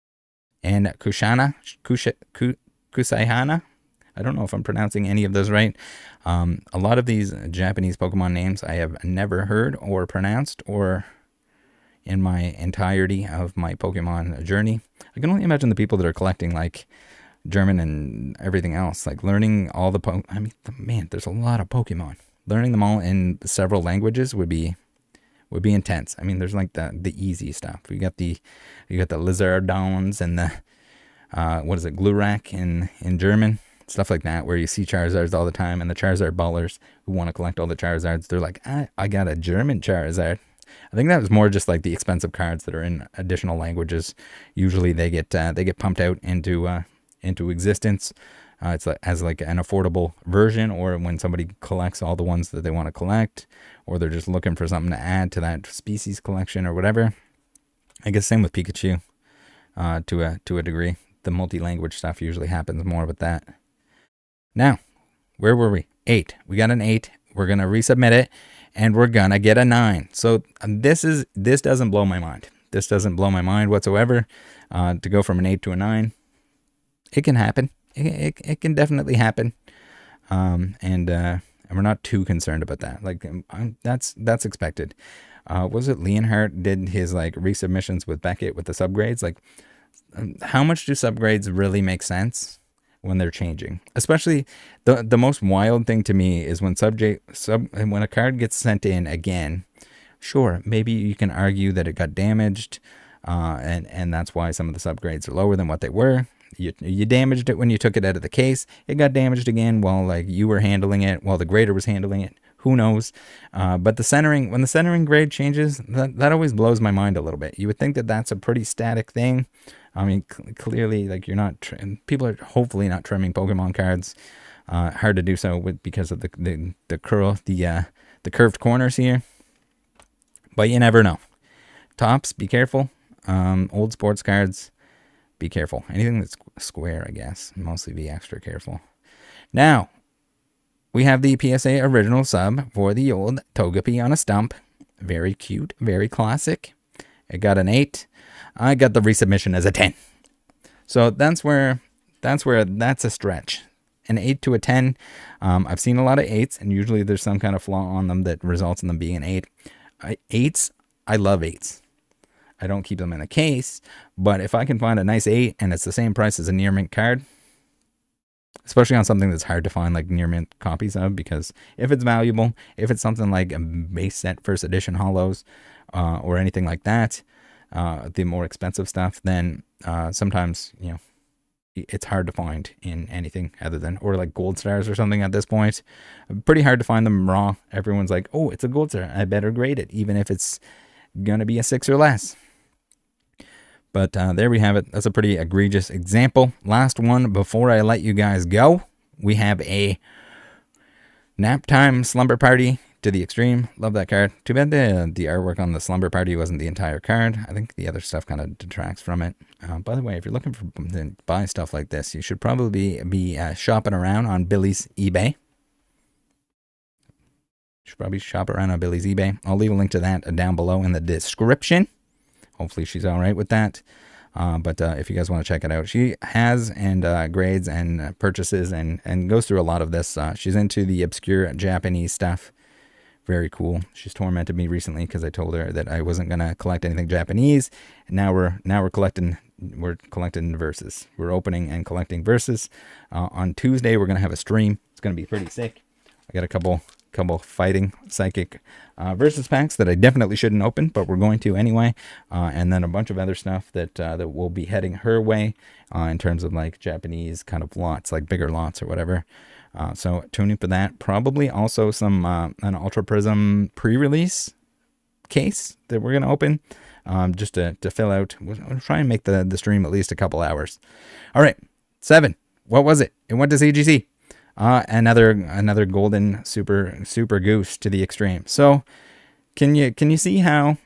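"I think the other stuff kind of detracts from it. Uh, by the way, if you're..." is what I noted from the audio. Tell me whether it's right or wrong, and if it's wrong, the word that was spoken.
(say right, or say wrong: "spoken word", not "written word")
right.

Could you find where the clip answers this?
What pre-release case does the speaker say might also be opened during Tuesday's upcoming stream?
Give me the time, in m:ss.
4:22.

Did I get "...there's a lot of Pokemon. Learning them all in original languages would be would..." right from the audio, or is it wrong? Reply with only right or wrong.
wrong.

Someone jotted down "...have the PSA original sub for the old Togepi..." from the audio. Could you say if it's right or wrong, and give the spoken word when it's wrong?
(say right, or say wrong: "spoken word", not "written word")
right.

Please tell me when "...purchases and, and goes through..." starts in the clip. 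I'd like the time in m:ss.
3:48.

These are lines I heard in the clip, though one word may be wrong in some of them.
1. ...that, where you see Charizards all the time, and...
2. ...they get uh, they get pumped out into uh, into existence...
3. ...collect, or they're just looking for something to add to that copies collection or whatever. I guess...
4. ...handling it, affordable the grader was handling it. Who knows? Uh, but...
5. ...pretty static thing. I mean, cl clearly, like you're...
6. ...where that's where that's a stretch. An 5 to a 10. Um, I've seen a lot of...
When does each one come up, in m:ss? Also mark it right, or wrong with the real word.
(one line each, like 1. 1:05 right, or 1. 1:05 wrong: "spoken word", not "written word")
1. 0:34 right
2. 0:44 right
3. 0:52 wrong: "species", not "copies"
4. 1:50 wrong: "while", not "affordable"
5. 1:58 right
6. 2:31 wrong: "8", not "5".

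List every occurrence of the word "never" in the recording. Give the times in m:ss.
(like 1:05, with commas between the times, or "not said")
0:09, 2:10.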